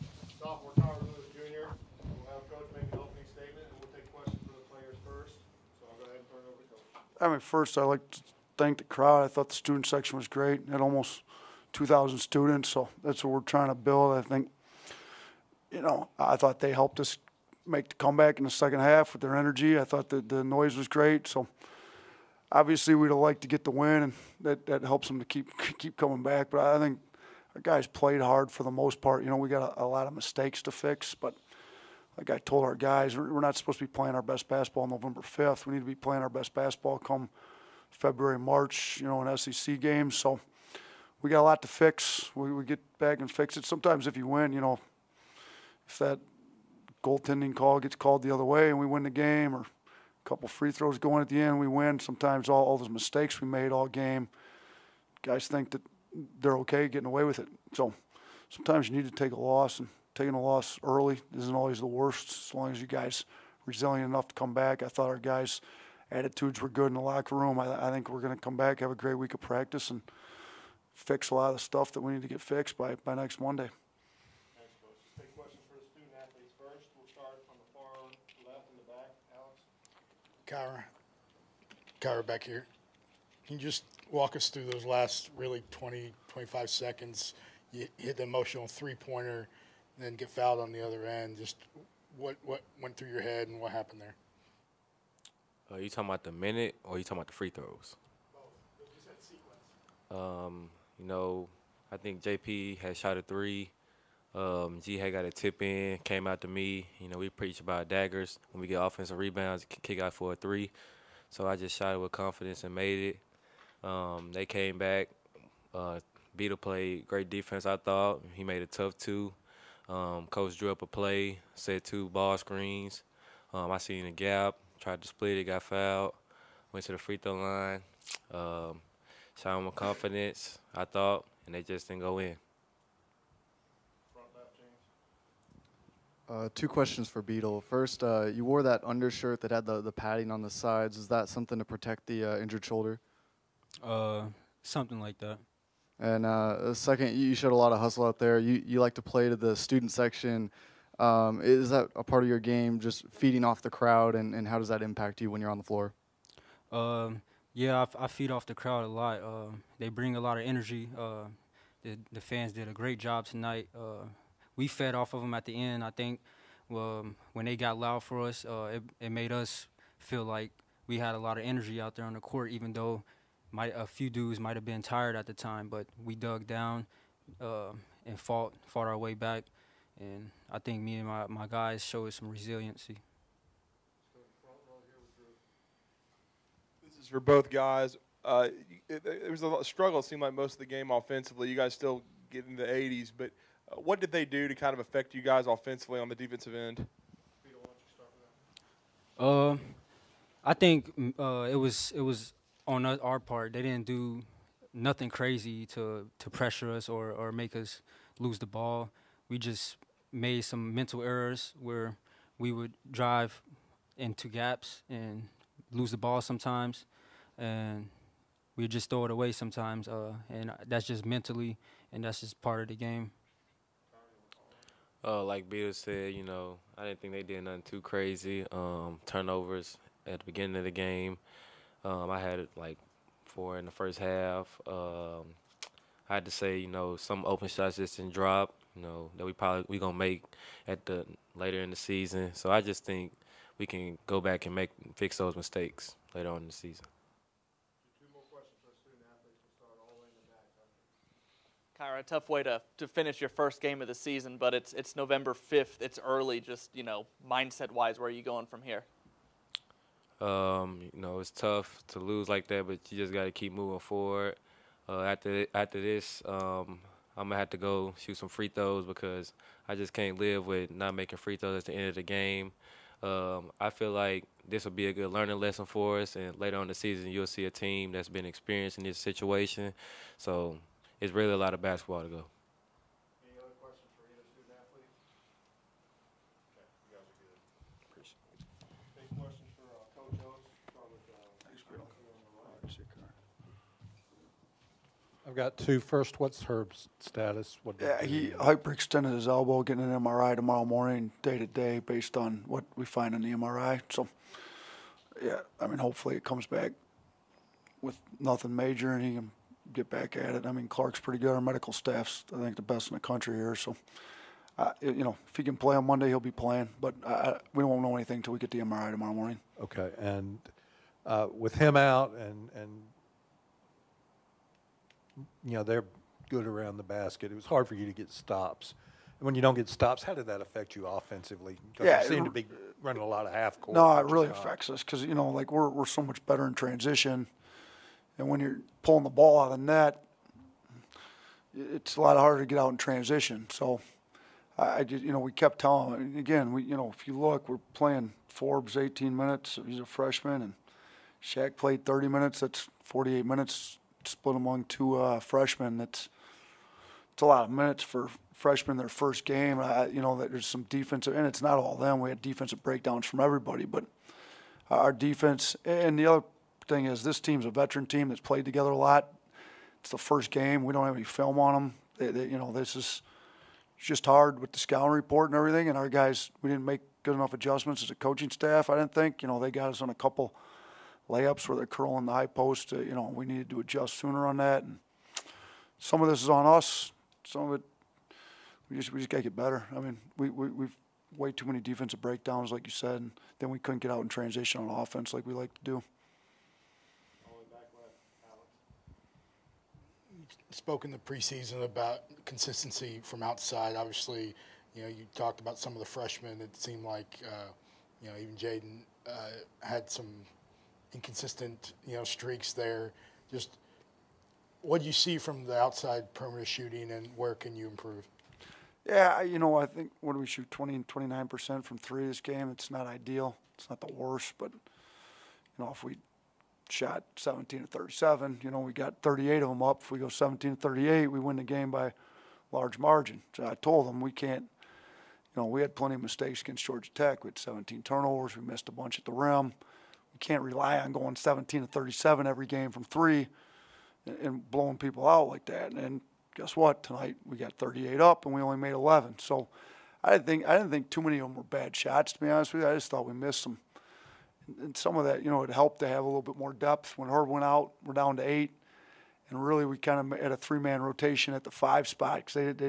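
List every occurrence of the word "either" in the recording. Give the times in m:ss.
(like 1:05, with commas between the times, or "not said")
4:44.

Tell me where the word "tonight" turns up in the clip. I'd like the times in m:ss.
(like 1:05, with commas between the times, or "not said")
2:43, 7:26.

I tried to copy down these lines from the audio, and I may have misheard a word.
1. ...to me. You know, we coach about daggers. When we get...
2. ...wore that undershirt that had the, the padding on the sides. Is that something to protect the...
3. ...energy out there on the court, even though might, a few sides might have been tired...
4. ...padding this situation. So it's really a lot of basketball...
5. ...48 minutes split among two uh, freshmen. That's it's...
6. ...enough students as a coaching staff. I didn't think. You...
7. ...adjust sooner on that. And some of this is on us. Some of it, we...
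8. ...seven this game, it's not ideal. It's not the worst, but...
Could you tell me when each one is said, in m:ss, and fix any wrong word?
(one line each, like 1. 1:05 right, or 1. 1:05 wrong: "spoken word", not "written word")
1. 1:46 wrong: "preach", not "coach"
2. 2:18 right
3. 2:51 wrong: "dudes", not "sides"
4. 4:38 wrong: "experiencing", not "padding"
5. 5:52 right
6. 6:17 wrong: "adjustments", not "students"
7. 6:23 right
8. 7:01 wrong: "three", not "seven".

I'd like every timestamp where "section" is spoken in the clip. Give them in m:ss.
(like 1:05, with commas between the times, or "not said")
0:09, 2:29.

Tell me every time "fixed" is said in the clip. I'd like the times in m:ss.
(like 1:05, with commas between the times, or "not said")
1:12.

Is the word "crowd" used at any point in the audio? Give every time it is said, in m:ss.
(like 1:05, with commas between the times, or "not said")
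0:08, 2:33, 2:38.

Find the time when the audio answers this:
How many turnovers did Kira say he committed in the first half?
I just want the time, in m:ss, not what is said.
3:53.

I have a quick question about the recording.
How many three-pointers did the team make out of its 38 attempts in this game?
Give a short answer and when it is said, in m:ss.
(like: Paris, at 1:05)
11, at 7:28.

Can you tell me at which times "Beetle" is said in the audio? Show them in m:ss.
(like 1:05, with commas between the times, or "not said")
1:56, 2:17.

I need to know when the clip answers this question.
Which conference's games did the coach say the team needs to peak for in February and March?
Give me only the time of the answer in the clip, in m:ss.
0:39.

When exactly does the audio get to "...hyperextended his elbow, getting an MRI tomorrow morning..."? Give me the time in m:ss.
4:58.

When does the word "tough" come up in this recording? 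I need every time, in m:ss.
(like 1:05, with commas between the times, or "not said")
1:58, 4:12, 4:21.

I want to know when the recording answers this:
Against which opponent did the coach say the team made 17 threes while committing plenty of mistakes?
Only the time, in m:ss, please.
7:16.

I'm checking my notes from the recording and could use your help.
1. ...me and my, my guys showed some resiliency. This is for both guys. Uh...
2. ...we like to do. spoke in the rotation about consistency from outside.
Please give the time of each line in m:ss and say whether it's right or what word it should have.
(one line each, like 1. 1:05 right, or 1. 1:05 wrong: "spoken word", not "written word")
1. 3:00 right
2. 6:35 wrong: "preseason", not "rotation".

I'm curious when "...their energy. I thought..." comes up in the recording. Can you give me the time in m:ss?
0:19.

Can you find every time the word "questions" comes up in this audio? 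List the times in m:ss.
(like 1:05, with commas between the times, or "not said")
0:04, 2:16, 4:43, 4:49.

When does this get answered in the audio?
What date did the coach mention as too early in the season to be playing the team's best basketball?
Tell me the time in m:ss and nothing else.
0:34.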